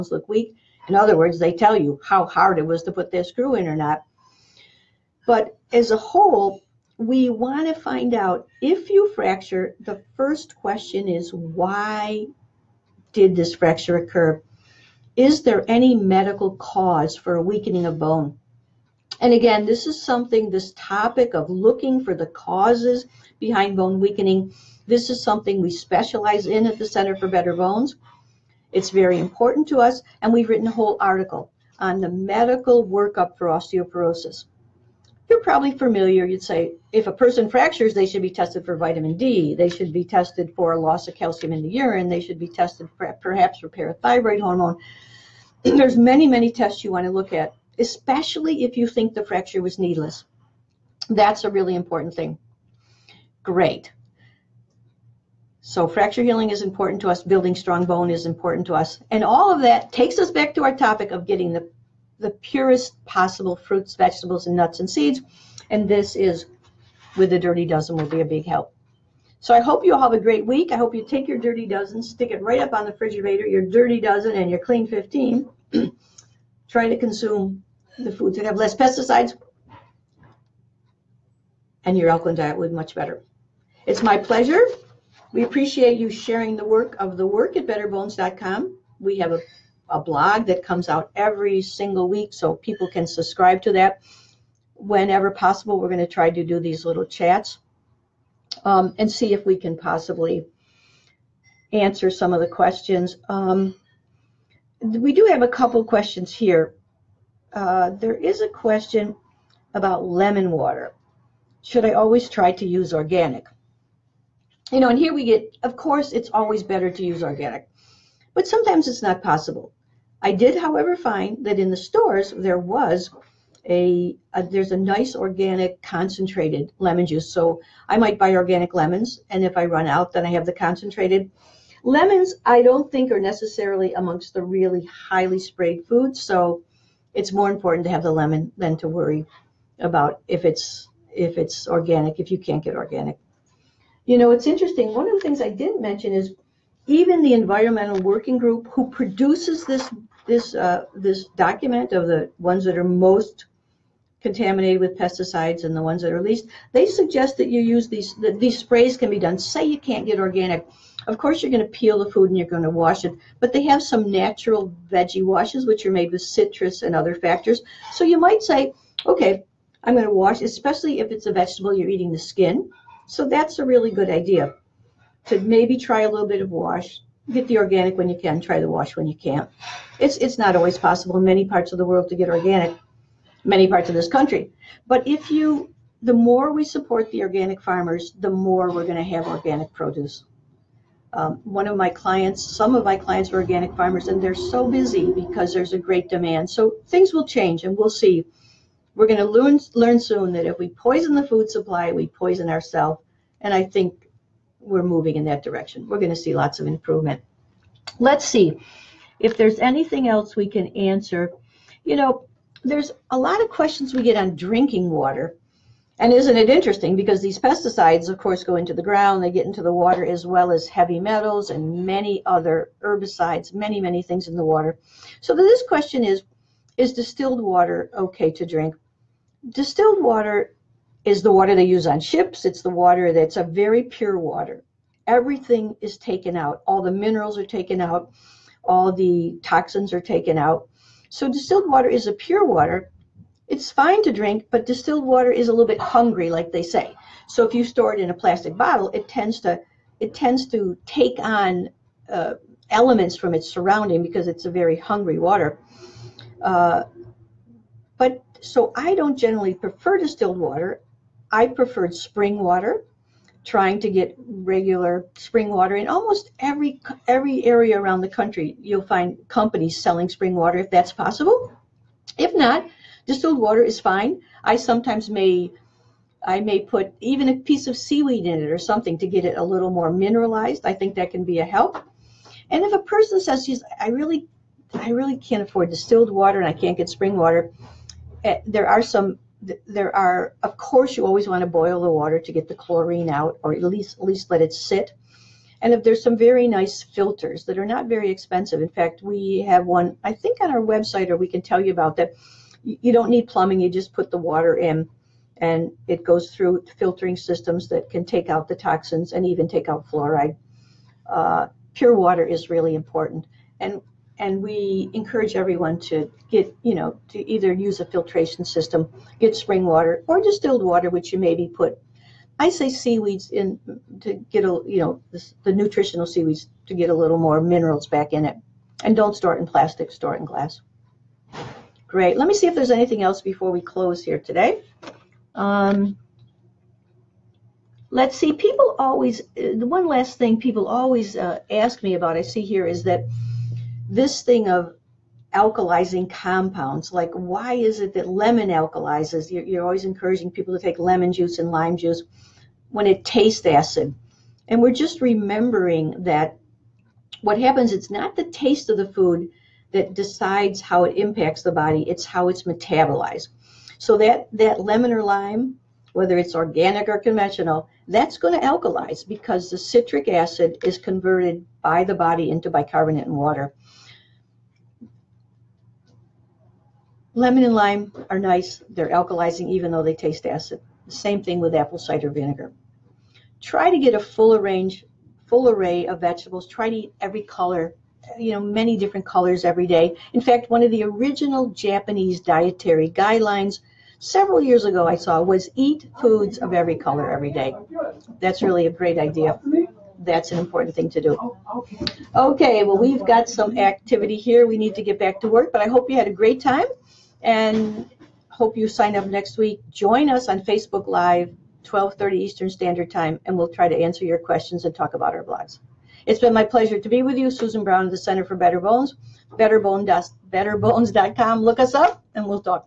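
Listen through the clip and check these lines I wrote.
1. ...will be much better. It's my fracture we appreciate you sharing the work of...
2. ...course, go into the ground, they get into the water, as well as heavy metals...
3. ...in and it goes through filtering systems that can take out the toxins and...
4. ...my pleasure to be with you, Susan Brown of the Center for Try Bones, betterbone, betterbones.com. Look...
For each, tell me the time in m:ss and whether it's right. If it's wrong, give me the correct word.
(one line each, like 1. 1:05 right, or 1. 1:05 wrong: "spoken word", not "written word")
1. 1:22 wrong: "pleasure", not "fracture"
2. 3:38 right
3. 5:04 right
4. 6:56 wrong: "Better", not "Try".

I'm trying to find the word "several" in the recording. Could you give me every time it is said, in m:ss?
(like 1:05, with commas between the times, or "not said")
6:33.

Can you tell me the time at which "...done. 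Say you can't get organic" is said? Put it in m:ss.
2:39.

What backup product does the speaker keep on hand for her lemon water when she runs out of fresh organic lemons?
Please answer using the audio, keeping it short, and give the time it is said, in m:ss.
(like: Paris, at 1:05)
Organic concentrated lemon juice, at 2:05.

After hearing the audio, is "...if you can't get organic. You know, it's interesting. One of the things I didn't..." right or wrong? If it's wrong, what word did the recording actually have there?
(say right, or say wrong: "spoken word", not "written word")
right.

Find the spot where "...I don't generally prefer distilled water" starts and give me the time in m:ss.
4:18.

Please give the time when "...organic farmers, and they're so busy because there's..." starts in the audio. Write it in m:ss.
3:13.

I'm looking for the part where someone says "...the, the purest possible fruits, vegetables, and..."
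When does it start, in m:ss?
1:01.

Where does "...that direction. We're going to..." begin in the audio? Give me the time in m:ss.
3:25.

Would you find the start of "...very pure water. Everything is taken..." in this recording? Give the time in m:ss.
3:53.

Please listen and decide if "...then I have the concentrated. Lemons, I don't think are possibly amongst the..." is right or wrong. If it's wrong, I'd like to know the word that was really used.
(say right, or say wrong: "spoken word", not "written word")
wrong: "necessarily", not "possibly".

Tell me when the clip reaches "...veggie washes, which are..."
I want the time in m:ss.
2:44.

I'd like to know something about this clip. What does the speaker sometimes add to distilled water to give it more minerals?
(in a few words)
Seaweed.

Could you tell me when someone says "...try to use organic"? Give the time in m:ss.
1:52.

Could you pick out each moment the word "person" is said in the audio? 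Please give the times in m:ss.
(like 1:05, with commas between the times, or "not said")
0:37, 4:42.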